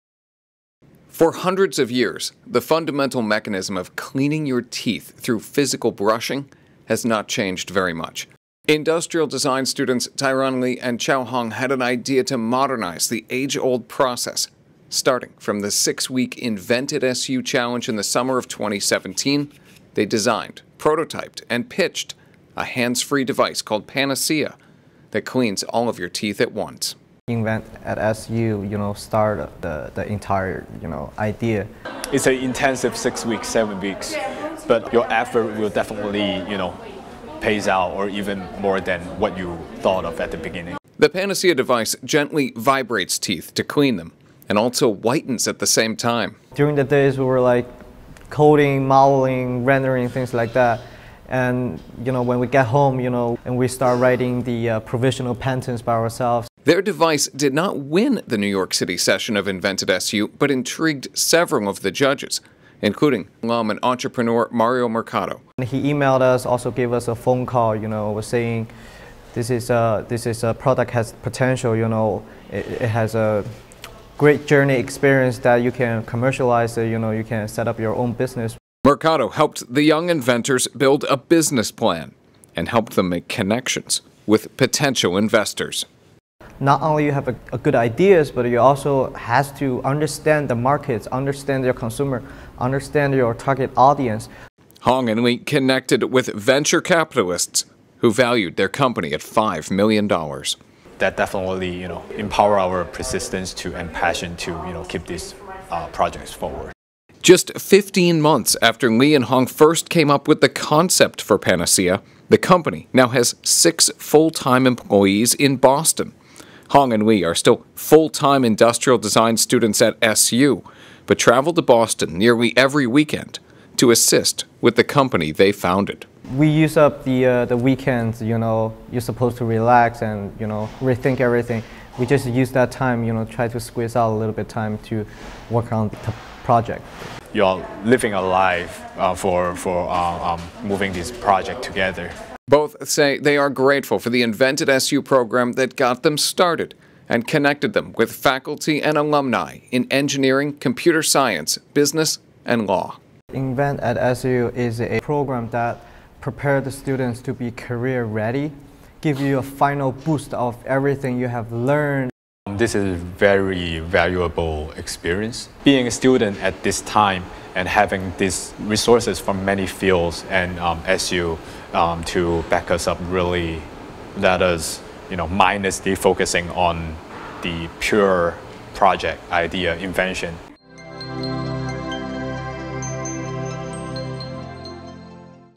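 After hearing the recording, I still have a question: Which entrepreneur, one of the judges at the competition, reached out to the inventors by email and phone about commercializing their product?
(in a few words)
Mario Mercado.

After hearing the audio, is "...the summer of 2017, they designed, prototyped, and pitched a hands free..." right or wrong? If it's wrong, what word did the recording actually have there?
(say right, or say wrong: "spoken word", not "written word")
right.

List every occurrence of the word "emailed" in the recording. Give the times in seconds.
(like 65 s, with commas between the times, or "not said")
65 s.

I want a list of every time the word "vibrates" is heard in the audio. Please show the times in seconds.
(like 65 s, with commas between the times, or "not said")
42 s.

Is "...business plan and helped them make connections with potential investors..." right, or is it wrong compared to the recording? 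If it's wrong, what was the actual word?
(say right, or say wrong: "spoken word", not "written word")
right.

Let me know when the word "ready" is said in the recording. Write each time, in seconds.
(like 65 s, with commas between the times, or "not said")
158 s.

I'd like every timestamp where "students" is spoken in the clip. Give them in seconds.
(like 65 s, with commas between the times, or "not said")
9 s, 119 s, 156 s, 165 s.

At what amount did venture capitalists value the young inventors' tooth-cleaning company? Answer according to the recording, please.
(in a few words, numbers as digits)
$5 million.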